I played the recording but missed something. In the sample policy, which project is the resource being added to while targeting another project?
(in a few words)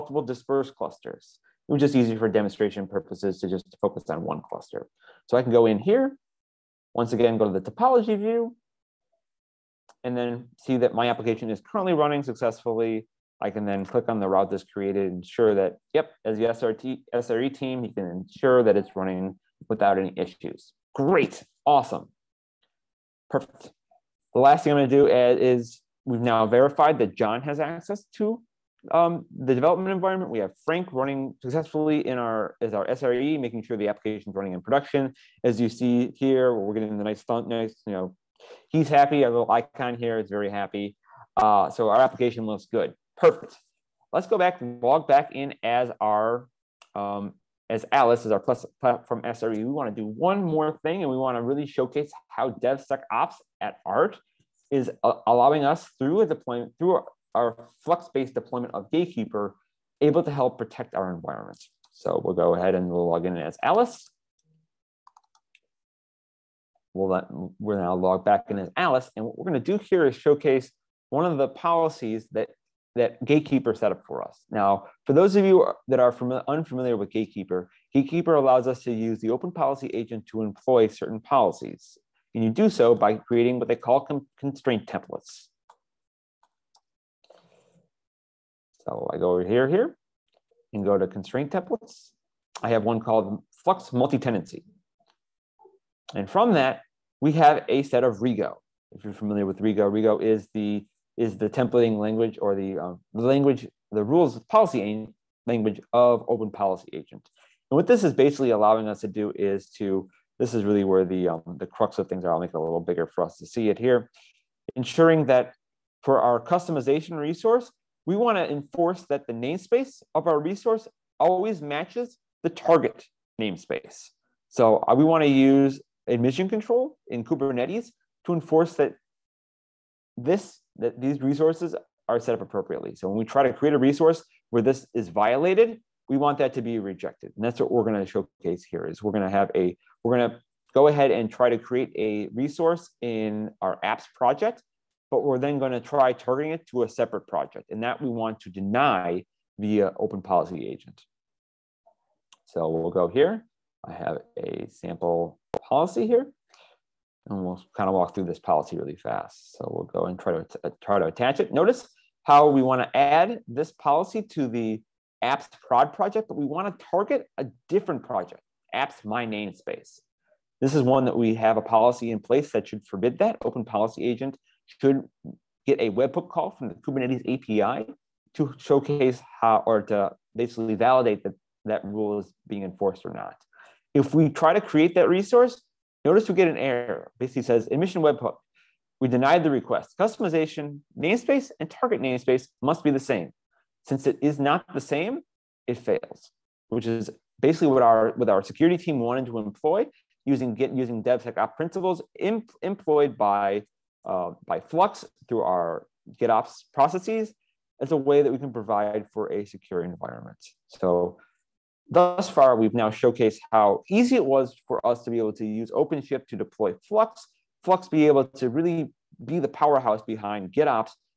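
apps prod.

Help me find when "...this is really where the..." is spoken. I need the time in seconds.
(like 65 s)
110 s.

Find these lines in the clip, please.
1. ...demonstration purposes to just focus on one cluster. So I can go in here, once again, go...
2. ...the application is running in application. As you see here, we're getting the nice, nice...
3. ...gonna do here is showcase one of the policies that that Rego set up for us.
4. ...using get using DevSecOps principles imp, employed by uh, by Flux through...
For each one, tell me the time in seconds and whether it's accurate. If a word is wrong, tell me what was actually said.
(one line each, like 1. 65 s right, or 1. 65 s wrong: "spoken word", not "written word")
1. 2 s right
2. 33 s wrong: "production", not "application"
3. 69 s wrong: "Gatekeeper", not "Rego"
4. 200 s right.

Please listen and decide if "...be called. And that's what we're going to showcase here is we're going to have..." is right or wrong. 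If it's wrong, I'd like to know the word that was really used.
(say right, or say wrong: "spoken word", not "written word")
wrong: "rejected", not "called".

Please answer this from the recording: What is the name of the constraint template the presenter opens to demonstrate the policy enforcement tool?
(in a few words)
Flux Multi-Tenancy.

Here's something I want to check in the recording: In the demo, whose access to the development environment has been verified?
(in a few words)
John.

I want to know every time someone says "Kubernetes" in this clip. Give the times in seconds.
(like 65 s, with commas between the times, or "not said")
127 s, 176 s.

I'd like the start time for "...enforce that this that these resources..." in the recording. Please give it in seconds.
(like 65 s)
128 s.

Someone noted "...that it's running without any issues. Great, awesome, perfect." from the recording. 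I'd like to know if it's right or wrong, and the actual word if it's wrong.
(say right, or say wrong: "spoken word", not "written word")
right.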